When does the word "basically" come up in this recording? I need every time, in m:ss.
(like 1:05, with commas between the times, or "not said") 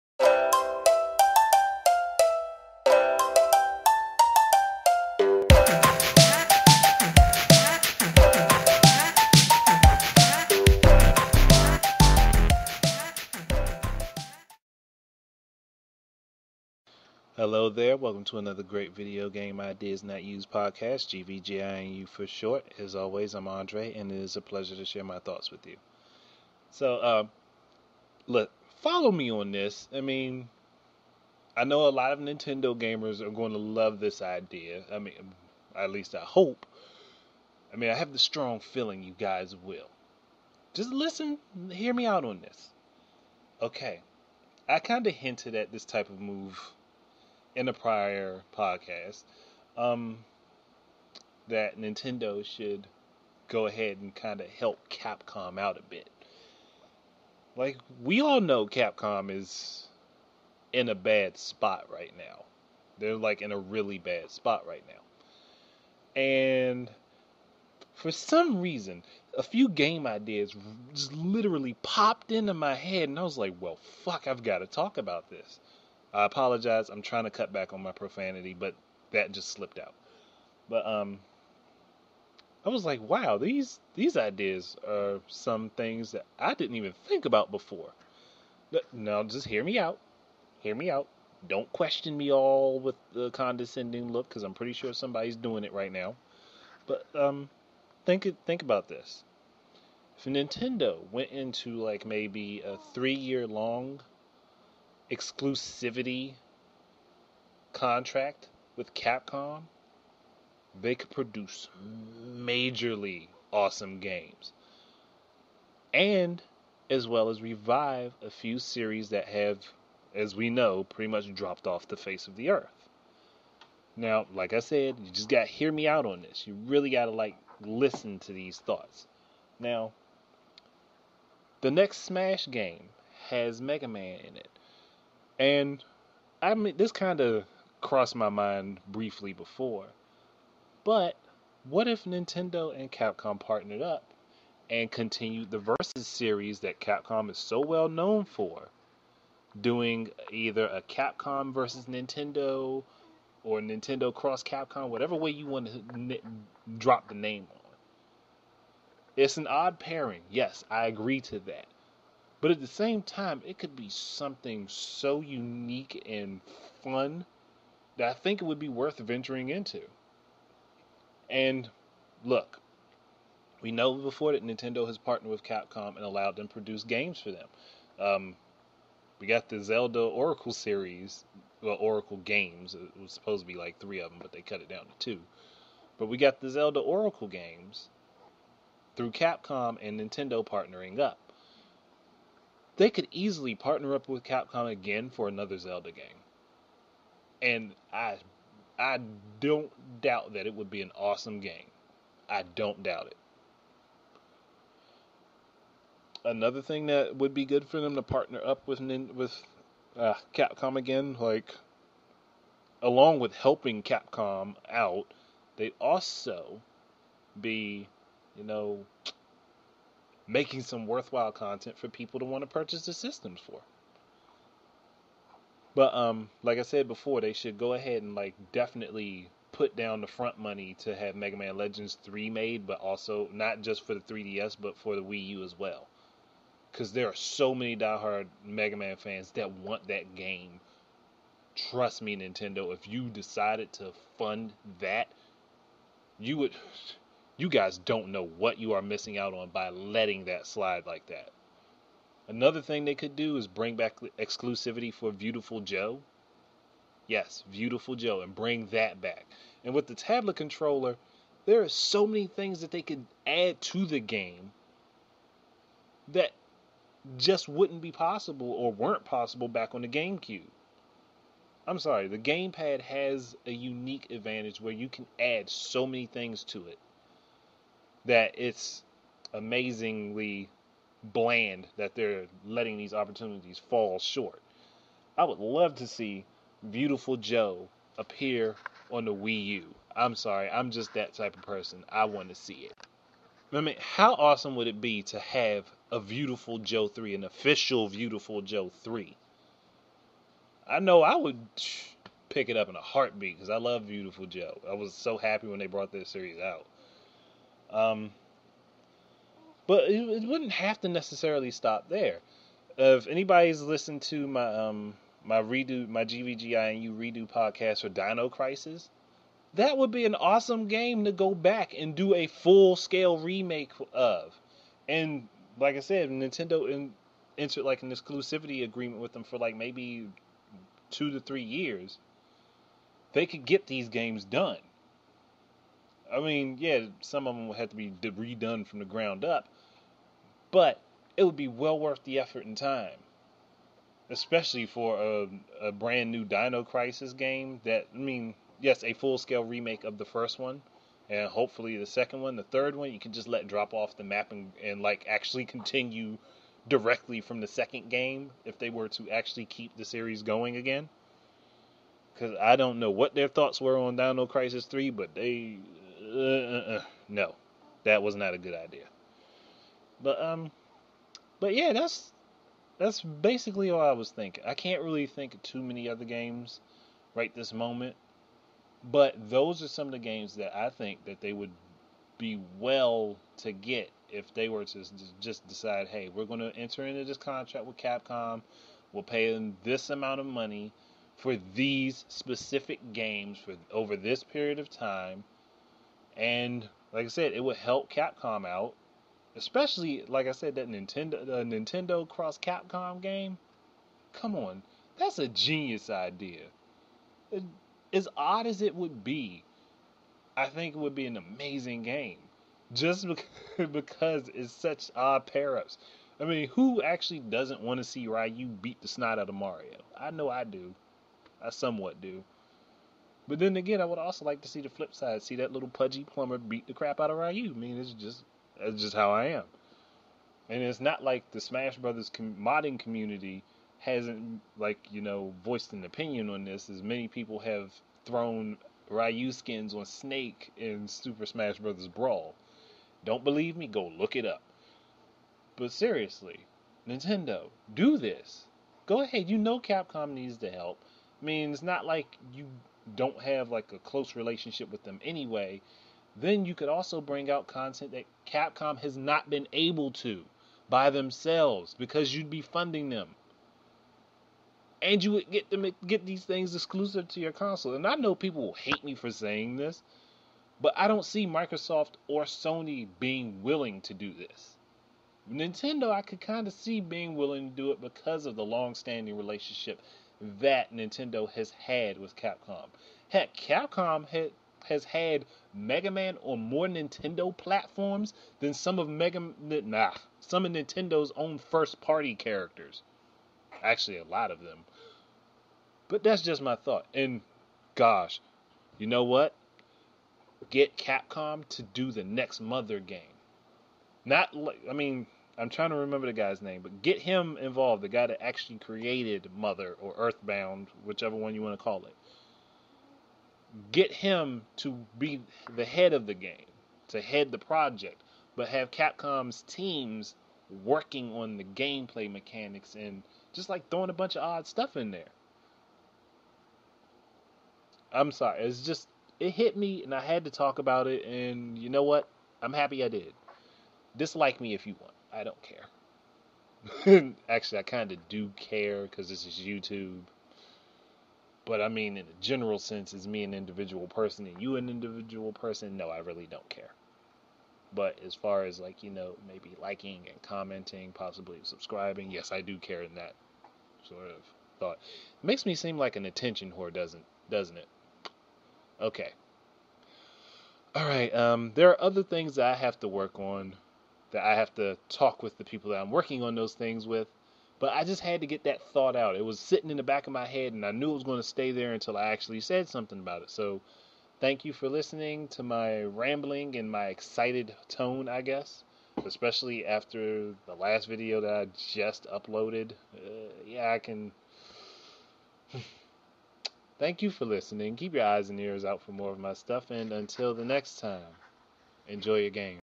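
6:13.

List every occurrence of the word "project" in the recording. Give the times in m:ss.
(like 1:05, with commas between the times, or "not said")
8:37.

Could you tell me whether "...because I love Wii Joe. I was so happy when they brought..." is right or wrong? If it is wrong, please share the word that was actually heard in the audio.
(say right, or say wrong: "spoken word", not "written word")
wrong: "Beautiful", not "Wii".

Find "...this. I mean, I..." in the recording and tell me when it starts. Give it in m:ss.
0:29.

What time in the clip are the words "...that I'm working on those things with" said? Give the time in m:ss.
9:25.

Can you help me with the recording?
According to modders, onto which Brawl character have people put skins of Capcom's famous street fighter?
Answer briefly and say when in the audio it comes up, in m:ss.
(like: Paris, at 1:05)
Snake, at 7:19.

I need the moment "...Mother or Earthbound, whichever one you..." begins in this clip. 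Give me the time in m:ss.
8:29.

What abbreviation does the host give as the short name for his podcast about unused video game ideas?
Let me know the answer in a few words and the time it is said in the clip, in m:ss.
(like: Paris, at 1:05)
GVGINU, at 0:21.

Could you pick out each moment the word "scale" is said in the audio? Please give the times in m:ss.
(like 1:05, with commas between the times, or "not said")
5:22, 5:49.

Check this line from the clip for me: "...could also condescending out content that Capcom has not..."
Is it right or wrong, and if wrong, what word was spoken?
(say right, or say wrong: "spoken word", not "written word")
wrong: "bring", not "condescending".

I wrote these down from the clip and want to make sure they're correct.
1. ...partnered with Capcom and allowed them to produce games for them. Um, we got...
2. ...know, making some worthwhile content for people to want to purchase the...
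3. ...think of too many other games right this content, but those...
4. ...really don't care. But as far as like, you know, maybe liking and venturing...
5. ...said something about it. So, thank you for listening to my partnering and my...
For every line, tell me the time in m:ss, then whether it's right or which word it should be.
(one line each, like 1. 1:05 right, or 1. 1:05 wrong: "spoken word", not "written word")
1. 2:54 right
2. 3:38 right
3. 6:15 wrong: "moment", not "content"
4. 9:05 wrong: "commenting", not "venturing"
5. 9:32 wrong: "rambling", not "partnering".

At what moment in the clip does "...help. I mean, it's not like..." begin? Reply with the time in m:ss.
7:30.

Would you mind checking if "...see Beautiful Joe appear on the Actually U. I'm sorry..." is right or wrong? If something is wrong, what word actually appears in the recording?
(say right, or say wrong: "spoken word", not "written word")
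wrong: "Wii", not "Actually".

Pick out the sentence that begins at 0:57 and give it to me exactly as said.
Like, we all know Capcom is in a bad spot right now.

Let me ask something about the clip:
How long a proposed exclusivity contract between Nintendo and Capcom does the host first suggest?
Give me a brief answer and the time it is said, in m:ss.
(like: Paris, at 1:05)
3 years, at 1:42.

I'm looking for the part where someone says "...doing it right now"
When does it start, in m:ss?
1:35.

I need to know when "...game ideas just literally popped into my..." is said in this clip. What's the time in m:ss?
1:09.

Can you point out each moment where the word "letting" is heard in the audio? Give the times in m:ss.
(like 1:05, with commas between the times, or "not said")
4:09, 4:42.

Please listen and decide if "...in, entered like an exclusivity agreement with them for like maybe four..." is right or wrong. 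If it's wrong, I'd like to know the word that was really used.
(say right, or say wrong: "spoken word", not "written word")
wrong: "two", not "four".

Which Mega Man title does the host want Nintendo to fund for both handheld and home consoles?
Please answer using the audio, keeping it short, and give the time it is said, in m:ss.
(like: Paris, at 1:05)
Mega Man Legends 3, at 3:51.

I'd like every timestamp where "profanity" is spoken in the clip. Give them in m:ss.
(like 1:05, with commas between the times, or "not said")
1:17.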